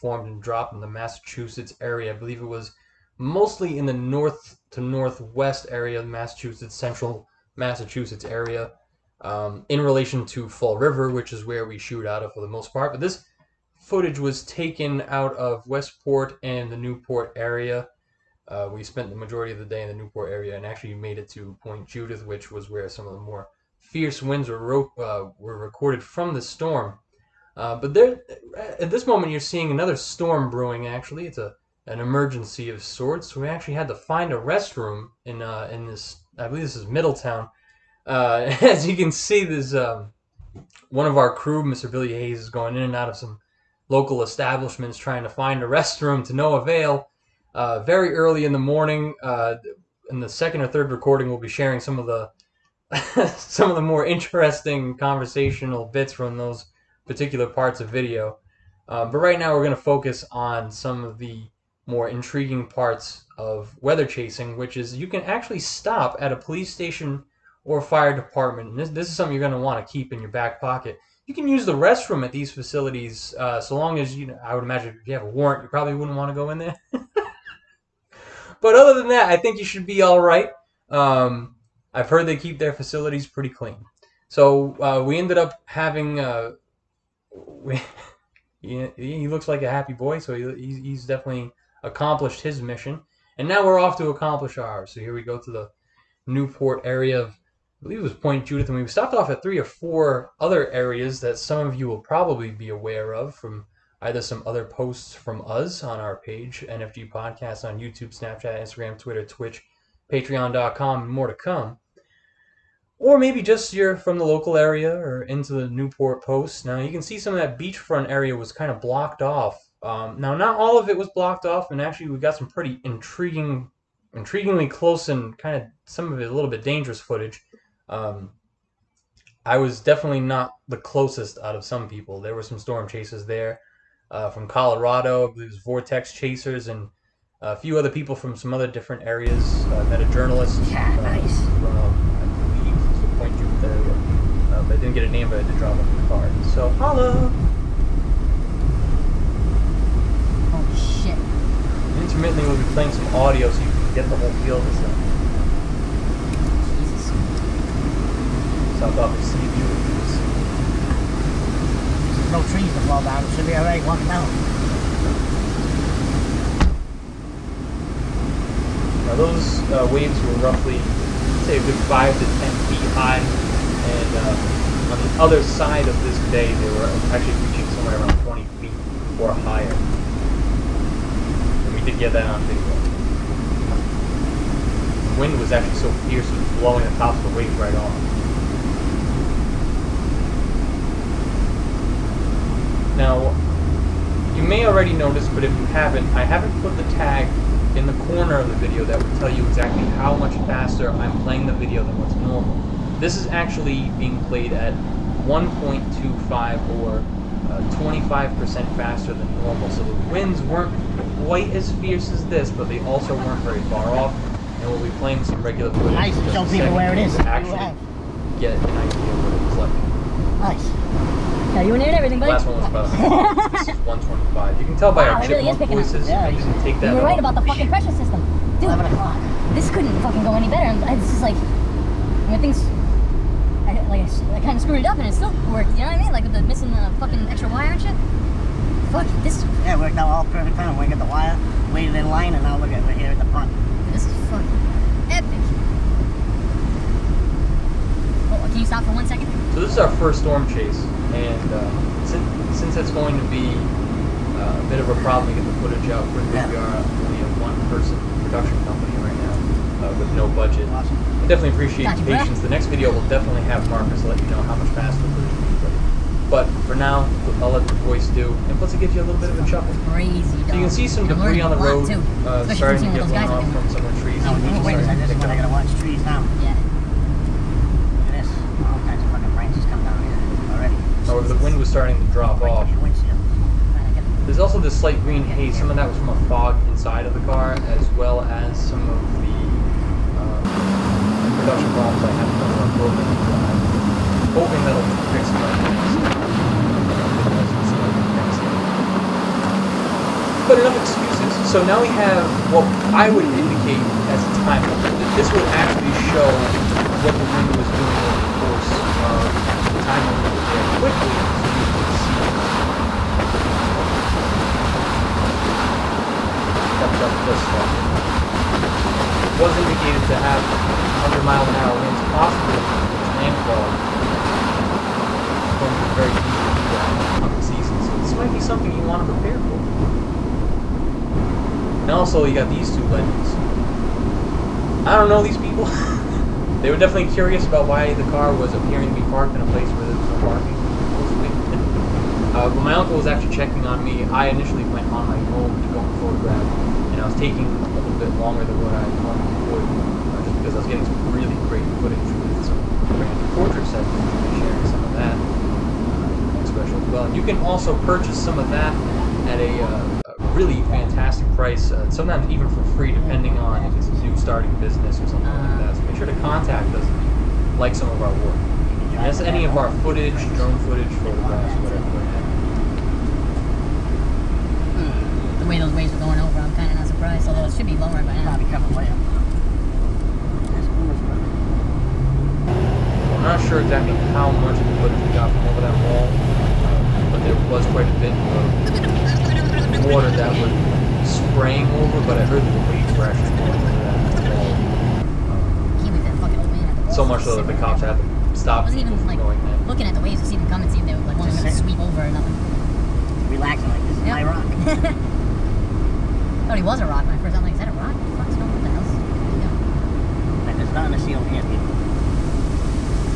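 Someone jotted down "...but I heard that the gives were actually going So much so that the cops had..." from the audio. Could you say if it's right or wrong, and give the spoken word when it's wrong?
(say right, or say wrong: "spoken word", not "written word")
wrong: "waves", not "gives".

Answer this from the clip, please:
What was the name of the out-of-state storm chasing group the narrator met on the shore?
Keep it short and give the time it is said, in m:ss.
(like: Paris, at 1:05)
Vortex chasers, at 2:15.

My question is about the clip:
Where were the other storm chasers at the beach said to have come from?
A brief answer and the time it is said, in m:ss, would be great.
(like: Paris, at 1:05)
Colorado, at 2:14.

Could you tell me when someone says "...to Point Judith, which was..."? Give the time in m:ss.
0:21.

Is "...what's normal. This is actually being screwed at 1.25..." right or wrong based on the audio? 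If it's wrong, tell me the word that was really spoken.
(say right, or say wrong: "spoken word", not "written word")
wrong: "played", not "screwed".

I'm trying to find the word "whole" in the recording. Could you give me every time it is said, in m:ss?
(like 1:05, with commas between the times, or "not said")
2:34.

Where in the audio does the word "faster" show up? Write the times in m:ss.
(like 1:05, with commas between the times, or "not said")
3:20, 3:28, 4:24.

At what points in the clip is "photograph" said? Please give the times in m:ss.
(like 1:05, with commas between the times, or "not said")
5:46, 6:11.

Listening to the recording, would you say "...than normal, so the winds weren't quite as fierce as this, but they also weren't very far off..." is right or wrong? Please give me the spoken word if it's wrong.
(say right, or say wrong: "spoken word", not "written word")
right.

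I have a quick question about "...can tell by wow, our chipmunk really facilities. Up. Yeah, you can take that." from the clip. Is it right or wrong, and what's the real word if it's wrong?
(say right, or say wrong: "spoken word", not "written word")
wrong: "voices", not "facilities".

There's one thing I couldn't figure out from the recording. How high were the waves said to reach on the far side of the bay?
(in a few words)
20 feet or higher.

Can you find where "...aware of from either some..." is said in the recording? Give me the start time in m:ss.
1:42.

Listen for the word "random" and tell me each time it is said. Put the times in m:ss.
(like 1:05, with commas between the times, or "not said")
5:52.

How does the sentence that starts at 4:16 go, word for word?
we are only a one-person production company right now uh, with no budget.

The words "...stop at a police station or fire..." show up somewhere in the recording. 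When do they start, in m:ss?
1:05.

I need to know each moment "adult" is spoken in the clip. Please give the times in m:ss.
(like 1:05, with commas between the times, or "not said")
not said.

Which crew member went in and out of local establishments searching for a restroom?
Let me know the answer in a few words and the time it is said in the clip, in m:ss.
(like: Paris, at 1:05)
Billy Haze, at 0:41.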